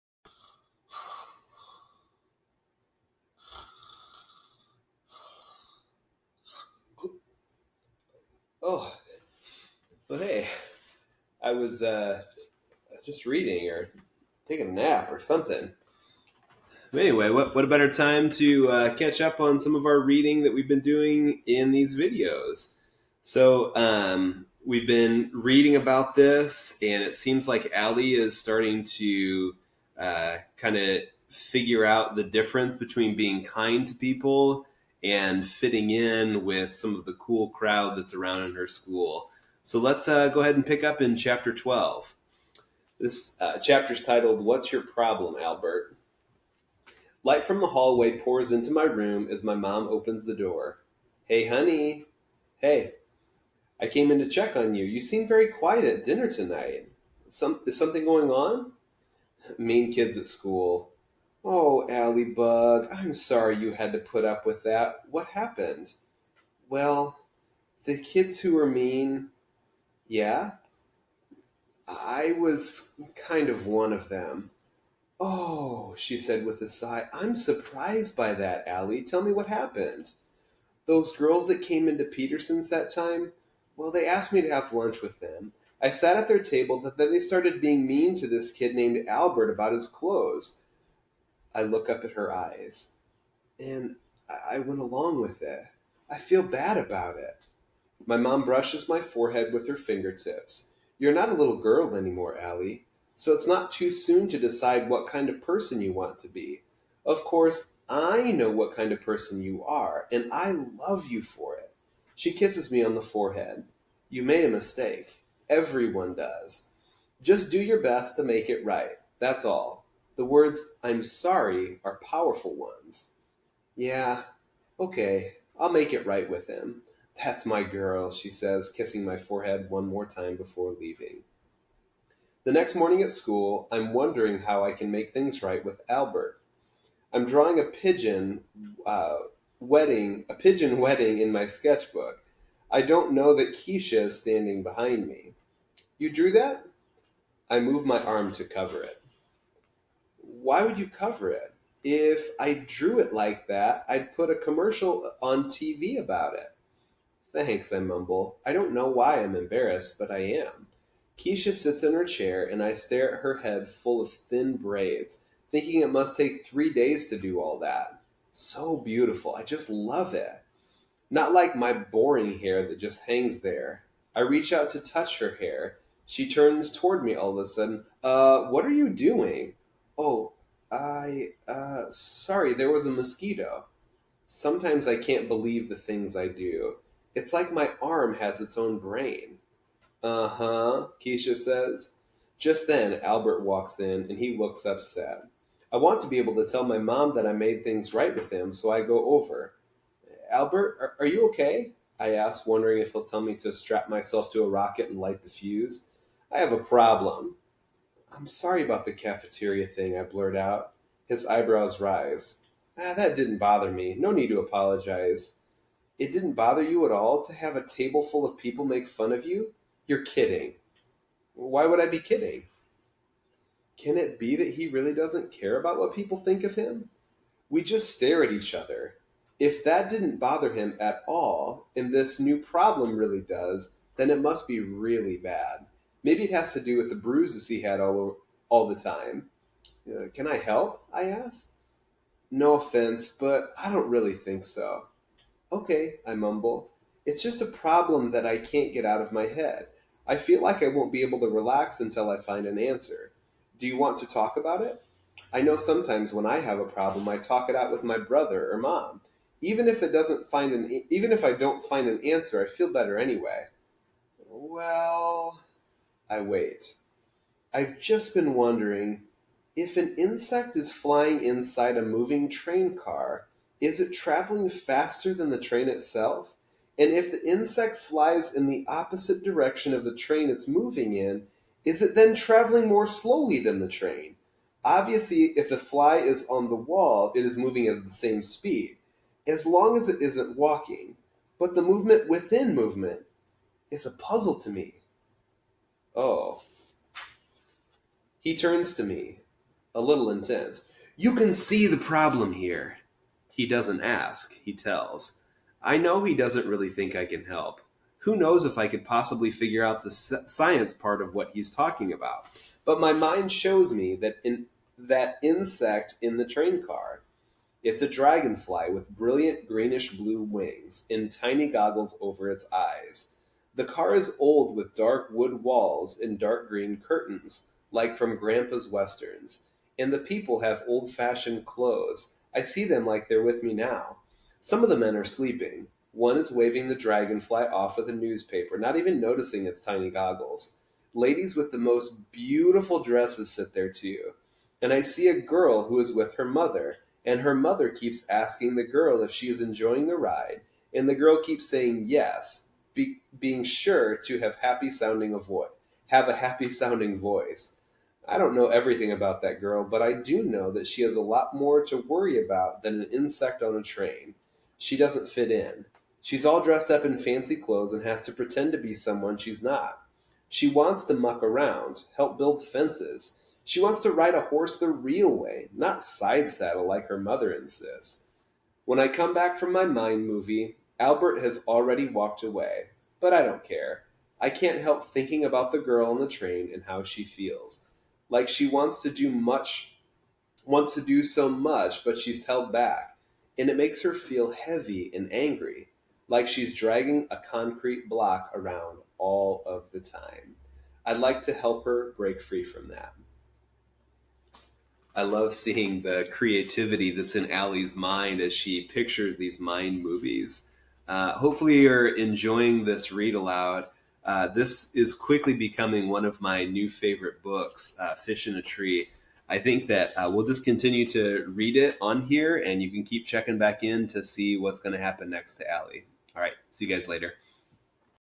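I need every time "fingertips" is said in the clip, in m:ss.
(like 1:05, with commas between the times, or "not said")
1:39.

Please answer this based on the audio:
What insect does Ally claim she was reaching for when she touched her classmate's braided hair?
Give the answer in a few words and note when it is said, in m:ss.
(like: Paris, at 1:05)
Mosquito, at 3:02.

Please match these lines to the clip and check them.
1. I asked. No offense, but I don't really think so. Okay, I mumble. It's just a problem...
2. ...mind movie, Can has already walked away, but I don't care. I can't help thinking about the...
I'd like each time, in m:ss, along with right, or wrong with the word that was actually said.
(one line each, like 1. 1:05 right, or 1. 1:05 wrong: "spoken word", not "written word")
1. 4:00 right
2. 6:19 wrong: "Albert", not "Can".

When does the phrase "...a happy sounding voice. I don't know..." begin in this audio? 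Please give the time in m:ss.
5:56.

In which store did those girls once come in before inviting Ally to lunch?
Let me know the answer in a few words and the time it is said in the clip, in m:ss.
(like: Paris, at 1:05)
Peterson's, at 1:22.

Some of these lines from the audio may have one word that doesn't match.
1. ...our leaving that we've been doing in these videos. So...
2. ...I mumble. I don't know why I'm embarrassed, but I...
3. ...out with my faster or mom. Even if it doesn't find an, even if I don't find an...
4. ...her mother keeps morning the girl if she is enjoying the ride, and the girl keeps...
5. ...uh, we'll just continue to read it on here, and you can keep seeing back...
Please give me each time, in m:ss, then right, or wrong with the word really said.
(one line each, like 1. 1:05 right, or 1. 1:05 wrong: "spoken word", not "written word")
1. 0:19 wrong: "reading", not "leaving"
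2. 2:37 right
3. 4:17 wrong: "brother", not "faster"
4. 5:47 wrong: "asking", not "morning"
5. 6:59 wrong: "checking", not "seeing".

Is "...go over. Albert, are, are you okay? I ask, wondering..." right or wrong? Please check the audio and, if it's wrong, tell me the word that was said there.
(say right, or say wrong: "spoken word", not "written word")
right.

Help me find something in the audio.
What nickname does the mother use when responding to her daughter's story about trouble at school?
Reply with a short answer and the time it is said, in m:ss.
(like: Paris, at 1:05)
Bug, at 1:02.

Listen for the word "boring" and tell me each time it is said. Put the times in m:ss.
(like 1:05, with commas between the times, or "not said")
2:51.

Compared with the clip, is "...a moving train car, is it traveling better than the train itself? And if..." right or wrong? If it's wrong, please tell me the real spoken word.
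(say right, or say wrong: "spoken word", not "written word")
wrong: "faster", not "better".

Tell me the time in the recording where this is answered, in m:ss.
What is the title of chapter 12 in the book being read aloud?
0:44.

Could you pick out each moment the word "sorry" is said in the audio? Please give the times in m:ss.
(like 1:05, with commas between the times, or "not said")
1:03, 2:01, 3:01, 3:28.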